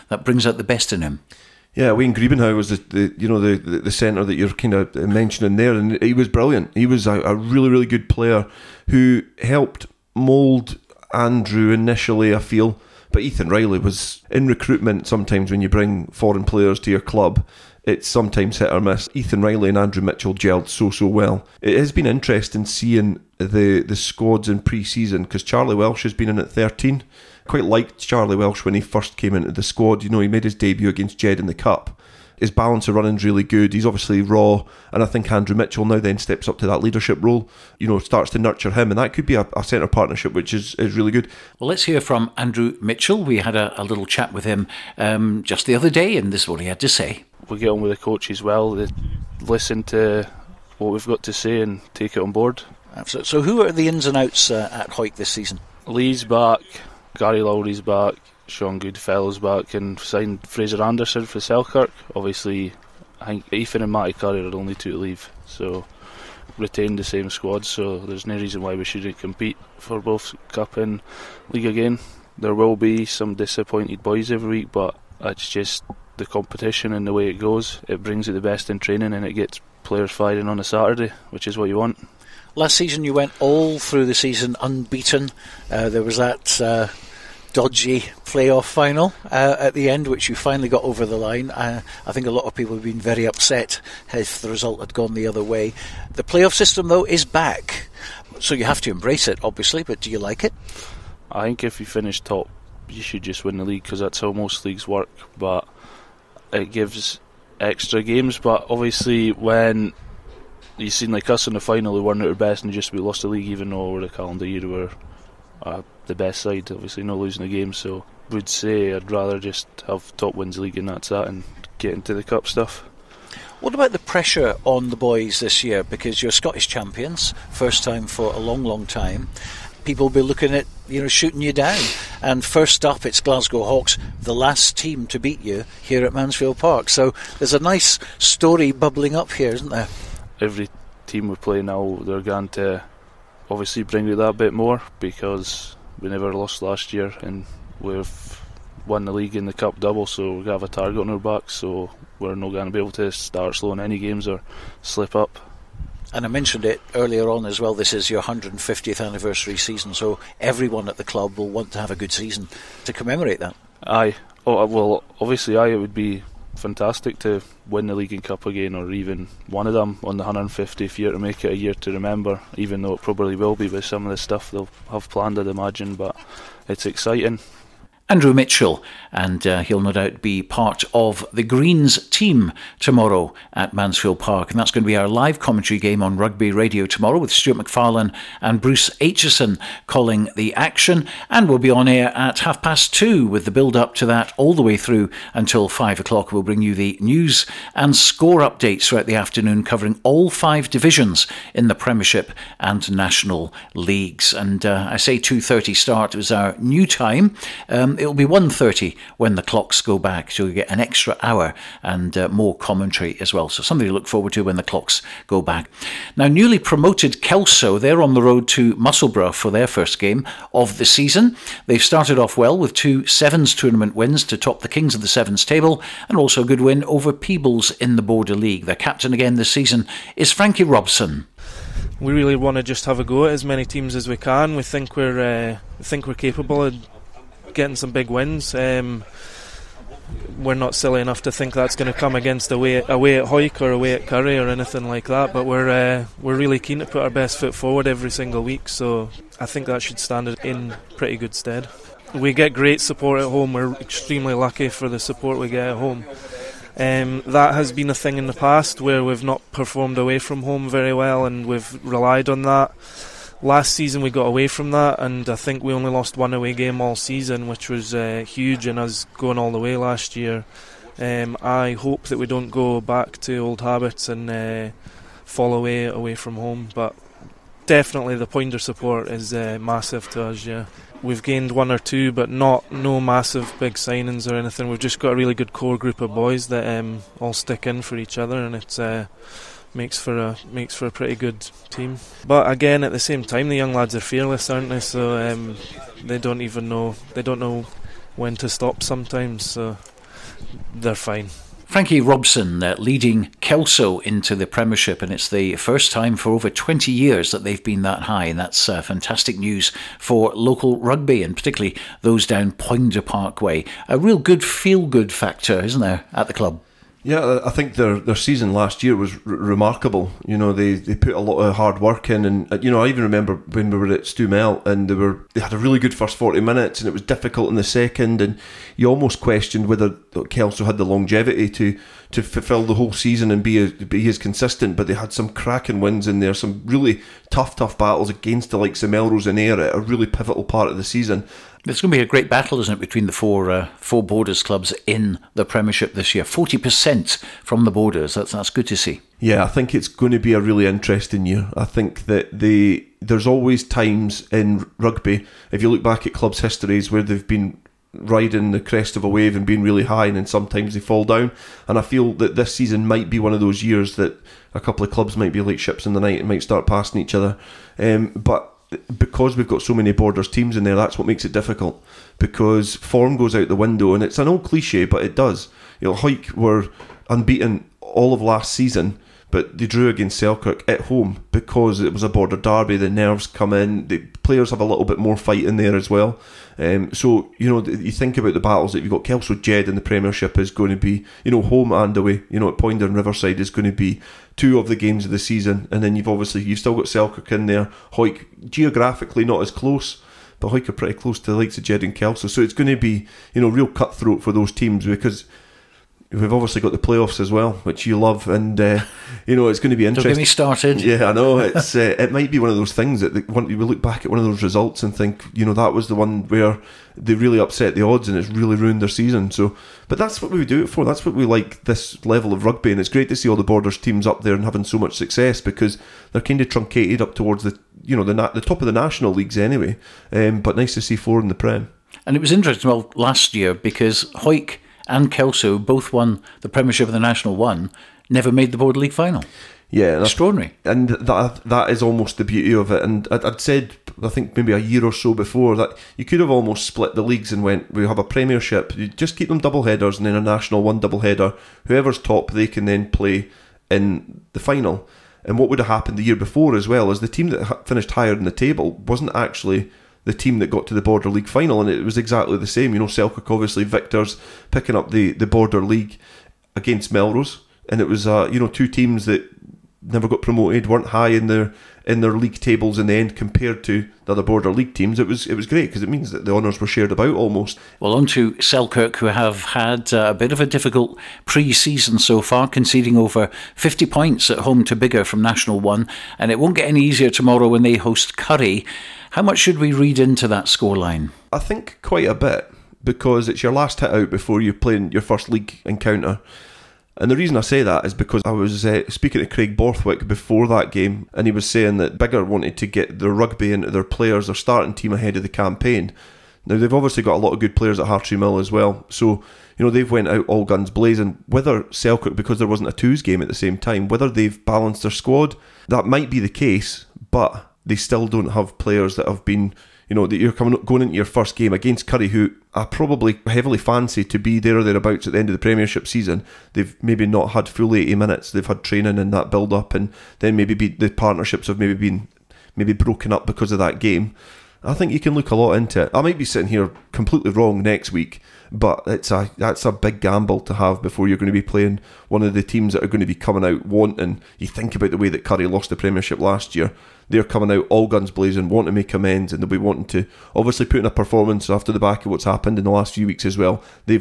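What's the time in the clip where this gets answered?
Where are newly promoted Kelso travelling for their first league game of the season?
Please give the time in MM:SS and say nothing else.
03:38.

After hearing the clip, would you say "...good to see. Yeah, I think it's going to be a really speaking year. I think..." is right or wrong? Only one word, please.
wrong.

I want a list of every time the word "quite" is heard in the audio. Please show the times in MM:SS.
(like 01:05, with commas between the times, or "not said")
00:27, 08:11.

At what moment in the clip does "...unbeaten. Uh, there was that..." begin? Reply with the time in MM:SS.
01:24.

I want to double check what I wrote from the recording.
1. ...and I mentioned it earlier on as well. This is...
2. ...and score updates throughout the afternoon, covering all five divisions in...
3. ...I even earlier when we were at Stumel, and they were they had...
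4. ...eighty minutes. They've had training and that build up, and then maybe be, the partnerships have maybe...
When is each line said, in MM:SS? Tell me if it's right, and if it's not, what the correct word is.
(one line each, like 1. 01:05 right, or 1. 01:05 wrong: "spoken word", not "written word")
1. 02:36 right
2. 03:17 right
3. 05:22 wrong: "remember", not "earlier"
4. 08:47 right.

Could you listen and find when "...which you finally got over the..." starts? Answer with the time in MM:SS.
01:30.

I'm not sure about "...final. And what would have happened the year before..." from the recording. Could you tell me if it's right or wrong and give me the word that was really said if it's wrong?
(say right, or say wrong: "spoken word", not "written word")
right.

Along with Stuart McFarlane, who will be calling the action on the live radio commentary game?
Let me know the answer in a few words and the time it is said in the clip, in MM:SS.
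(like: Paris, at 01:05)
Bruce Aitchison, at 03:08.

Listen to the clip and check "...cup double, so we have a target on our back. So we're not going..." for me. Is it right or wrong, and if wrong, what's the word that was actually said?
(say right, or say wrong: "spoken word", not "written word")
right.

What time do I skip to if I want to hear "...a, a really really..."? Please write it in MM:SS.
00:07.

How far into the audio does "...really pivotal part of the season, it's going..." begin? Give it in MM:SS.
05:39.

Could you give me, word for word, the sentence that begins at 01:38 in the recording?
So you have to embrace it, obviously, but do you like it?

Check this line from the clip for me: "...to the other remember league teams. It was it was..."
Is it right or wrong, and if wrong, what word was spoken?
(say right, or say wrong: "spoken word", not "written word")
wrong: "border", not "remember".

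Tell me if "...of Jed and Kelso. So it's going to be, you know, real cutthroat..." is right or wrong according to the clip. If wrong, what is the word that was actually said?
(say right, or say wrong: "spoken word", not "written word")
right.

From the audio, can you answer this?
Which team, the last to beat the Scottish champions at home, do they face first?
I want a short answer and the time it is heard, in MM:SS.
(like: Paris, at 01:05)
Glasgow Hawks, at 02:13.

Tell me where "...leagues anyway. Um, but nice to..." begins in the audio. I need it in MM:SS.
07:09.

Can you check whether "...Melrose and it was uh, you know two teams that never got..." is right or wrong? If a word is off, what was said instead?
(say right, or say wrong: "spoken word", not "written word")
right.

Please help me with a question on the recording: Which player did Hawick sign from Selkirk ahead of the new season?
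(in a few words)
Fraser Anderson.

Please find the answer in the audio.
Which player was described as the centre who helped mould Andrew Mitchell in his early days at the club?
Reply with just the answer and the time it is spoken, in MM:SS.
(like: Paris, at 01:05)
Wayne Griebenhauer, at 00:01.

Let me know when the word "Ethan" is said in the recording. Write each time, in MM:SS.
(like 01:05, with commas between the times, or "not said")
00:13, 00:19, 01:03.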